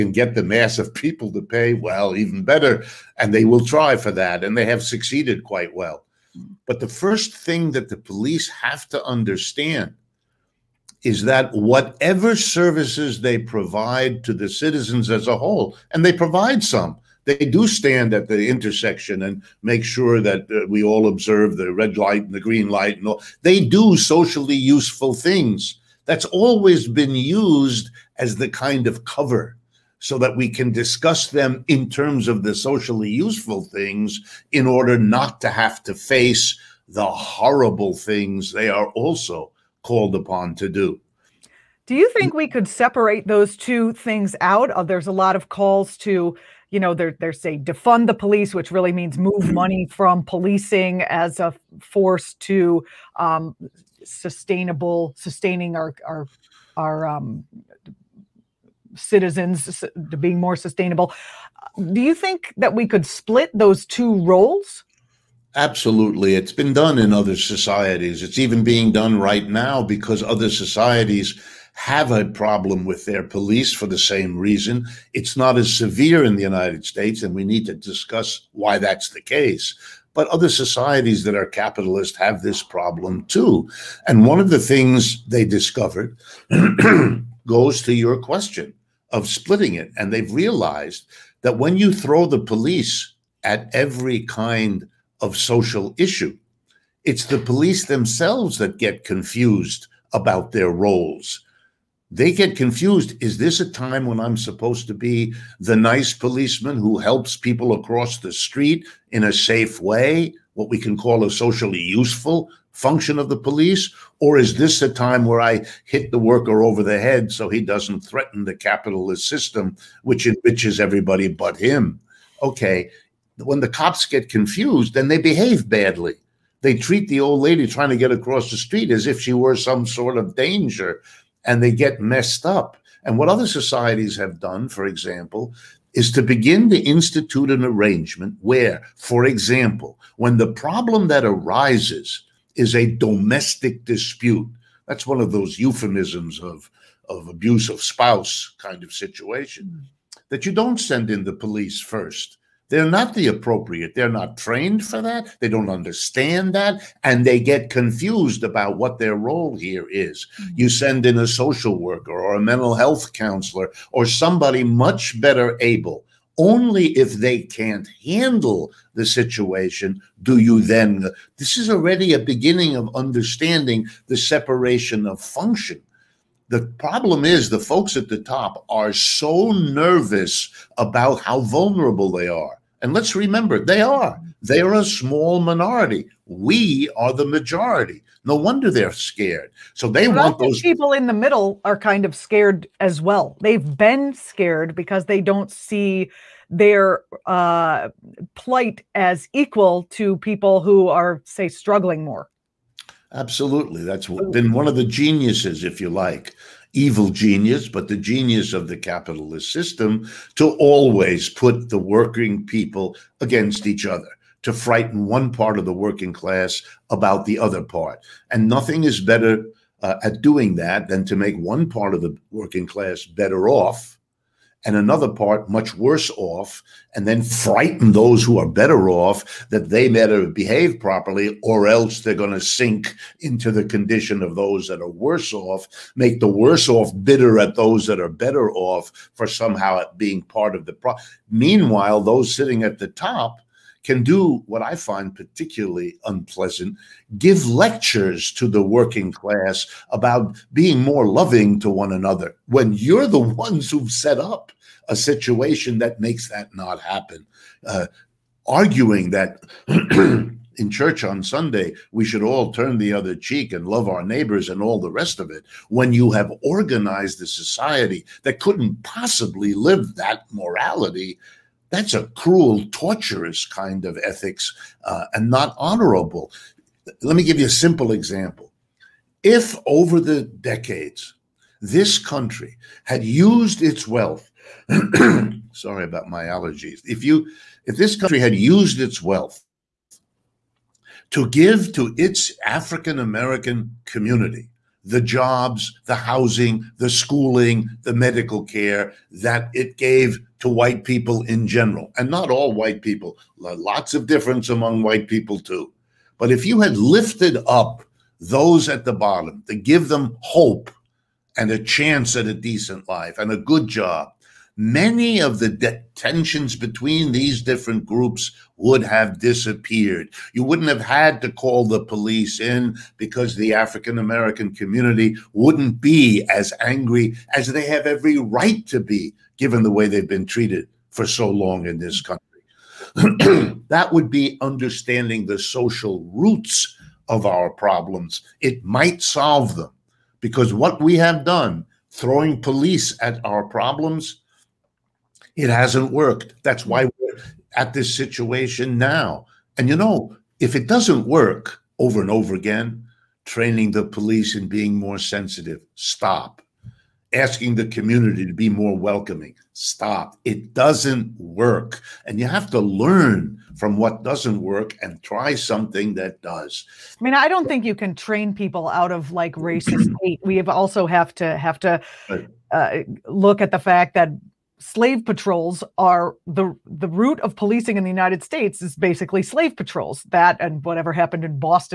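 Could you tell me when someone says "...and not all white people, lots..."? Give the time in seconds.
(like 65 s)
301 s.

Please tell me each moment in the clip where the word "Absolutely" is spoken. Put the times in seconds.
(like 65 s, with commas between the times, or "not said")
65 s, 203 s.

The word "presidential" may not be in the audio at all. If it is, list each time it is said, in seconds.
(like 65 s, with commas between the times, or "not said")
not said.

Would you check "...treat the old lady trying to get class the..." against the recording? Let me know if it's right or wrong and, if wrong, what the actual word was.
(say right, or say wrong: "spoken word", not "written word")
wrong: "across", not "class".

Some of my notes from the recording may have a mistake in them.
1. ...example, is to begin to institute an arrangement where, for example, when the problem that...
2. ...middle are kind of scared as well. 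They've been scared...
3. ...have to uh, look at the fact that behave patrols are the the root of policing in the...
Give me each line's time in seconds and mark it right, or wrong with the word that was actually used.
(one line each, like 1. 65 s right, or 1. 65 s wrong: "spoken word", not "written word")
1. 134 s right
2. 191 s right
3. 371 s wrong: "slave", not "behave".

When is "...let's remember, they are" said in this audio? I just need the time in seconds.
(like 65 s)
182 s.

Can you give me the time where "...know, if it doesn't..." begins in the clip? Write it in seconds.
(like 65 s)
349 s.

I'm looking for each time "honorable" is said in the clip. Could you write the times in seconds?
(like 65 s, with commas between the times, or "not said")
275 s.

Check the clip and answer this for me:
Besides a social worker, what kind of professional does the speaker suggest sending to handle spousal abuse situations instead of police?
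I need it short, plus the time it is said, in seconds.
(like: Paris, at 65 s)
mental health counselor, at 162 s.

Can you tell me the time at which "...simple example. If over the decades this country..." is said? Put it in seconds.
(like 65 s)
277 s.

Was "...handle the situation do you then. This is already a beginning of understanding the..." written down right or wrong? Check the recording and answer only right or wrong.
right.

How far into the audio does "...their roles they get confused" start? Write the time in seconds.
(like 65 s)
100 s.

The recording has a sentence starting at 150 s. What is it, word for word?
that you don't send in the police first they're not the appropriate.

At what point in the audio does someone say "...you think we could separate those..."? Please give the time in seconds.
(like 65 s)
41 s.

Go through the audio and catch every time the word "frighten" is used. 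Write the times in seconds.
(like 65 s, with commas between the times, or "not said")
214 s, 227 s.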